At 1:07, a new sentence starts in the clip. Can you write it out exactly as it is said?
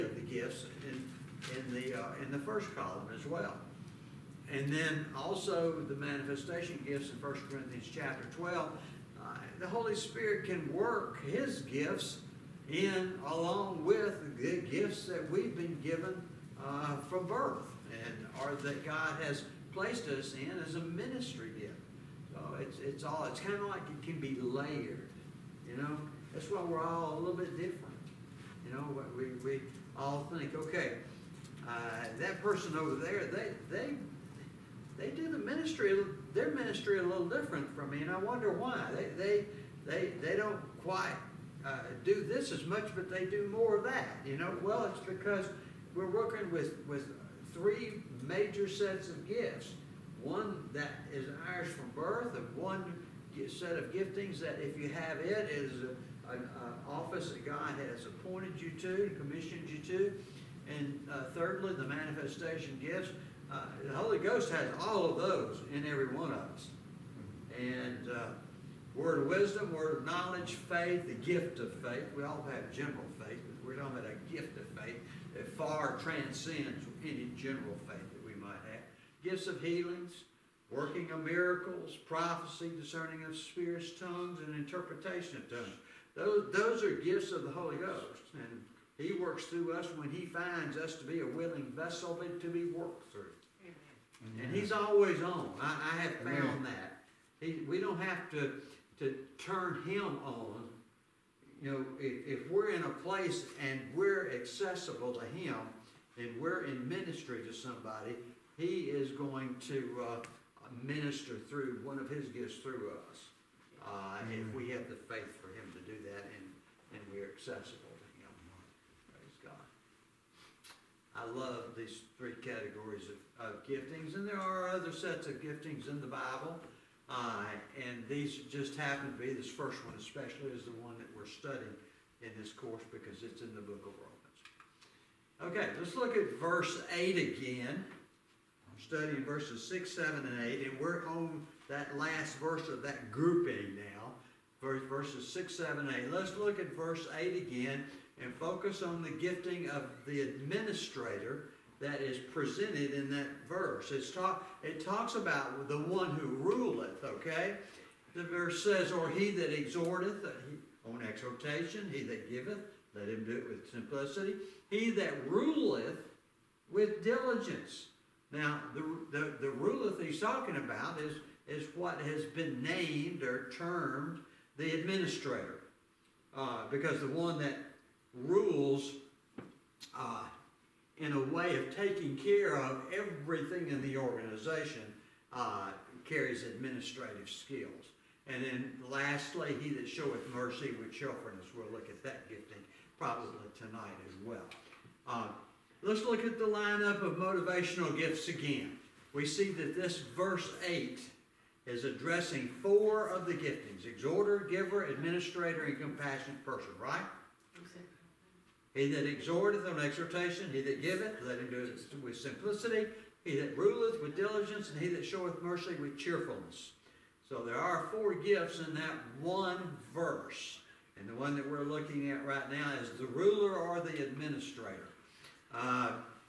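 And uh, word of wisdom, word of knowledge, faith, the gift of faith.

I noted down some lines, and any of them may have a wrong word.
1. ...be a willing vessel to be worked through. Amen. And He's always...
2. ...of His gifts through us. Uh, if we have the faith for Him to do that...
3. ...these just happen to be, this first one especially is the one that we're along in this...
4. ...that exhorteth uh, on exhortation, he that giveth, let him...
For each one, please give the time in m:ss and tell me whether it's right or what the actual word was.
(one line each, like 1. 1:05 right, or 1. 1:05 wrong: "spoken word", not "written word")
1. 1:31 right
2. 1:51 right
3. 2:08 wrong: "studying", not "along"
4. 2:39 right.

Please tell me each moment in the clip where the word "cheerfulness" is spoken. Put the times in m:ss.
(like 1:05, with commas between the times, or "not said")
3:10, 3:35.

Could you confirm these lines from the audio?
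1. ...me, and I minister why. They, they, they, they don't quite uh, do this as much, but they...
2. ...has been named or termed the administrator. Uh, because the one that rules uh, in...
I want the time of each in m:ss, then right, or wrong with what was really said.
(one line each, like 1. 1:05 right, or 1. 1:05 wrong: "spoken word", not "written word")
1. 0:37 wrong: "wonder", not "minister"
2. 2:52 right.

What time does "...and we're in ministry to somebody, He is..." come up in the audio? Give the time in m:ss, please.
1:46.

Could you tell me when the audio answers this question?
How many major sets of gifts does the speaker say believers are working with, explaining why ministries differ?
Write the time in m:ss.
0:47.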